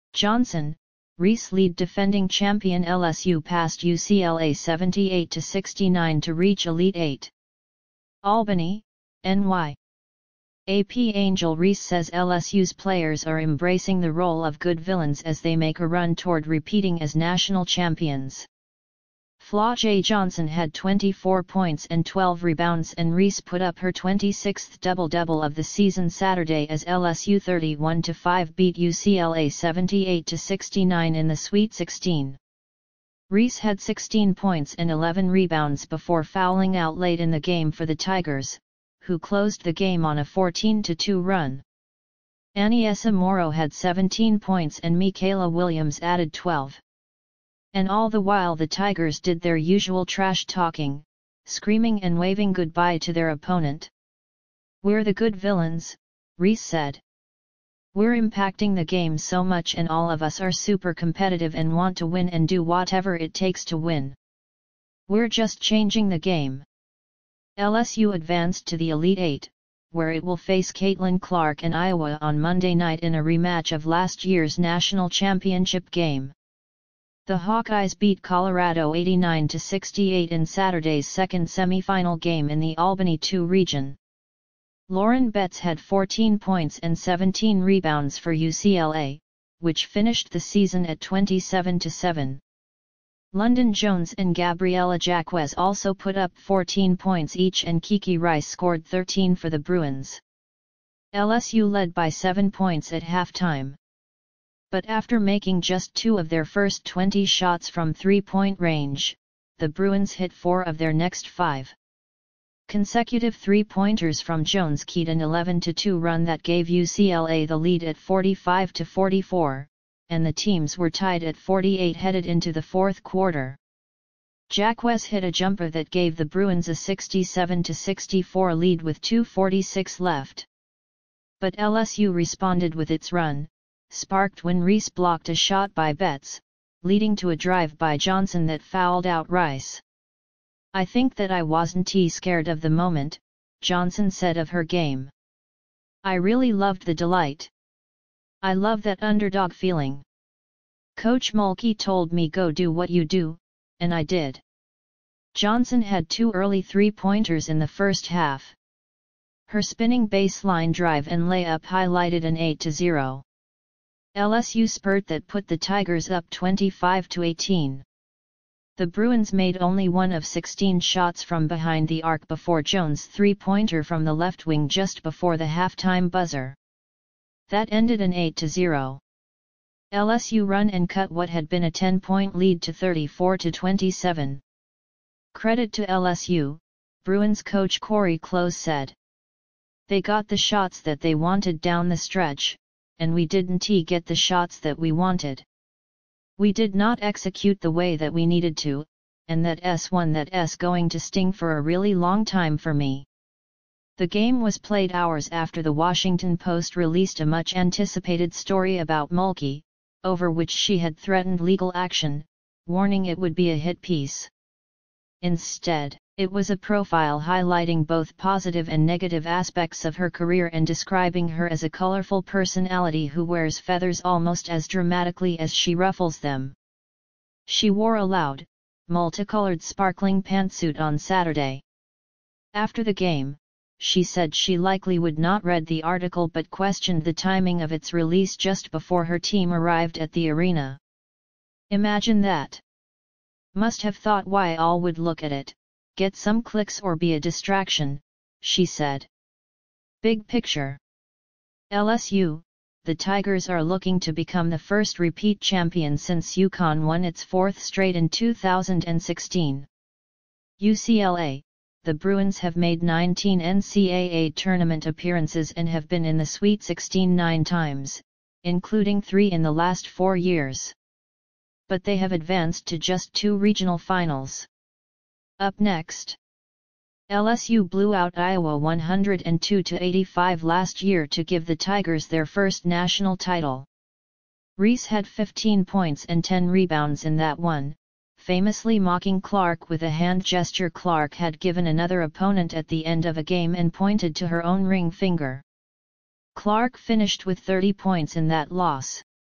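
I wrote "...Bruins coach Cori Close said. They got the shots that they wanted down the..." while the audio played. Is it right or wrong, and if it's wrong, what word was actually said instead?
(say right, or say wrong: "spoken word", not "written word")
right.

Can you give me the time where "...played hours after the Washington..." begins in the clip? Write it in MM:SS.
03:24.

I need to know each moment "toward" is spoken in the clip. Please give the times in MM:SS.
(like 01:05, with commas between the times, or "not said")
00:16.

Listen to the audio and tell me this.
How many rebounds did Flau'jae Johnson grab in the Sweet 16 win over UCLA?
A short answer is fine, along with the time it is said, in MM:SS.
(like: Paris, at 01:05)
12, at 00:22.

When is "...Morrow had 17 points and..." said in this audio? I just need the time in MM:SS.
00:43.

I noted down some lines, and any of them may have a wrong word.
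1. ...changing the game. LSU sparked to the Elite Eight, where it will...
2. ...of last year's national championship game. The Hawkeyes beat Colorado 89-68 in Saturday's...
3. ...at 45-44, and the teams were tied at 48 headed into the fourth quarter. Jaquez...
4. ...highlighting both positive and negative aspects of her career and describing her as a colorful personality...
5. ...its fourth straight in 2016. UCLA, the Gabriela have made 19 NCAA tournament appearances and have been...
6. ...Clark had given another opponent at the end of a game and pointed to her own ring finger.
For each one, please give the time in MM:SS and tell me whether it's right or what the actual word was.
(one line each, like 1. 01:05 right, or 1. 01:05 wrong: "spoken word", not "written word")
1. 01:05 wrong: "advanced", not "sparked"
2. 01:13 right
3. 01:57 right
4. 03:37 right
5. 04:17 wrong: "Bruins", not "Gabriela"
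6. 04:50 right.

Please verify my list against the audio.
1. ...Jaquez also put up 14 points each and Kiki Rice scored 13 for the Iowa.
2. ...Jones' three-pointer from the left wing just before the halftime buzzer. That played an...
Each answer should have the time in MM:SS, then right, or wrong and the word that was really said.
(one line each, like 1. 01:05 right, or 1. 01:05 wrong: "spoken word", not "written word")
1. 01:34 wrong: "Bruins", not "Iowa"
2. 02:52 wrong: "ended", not "played".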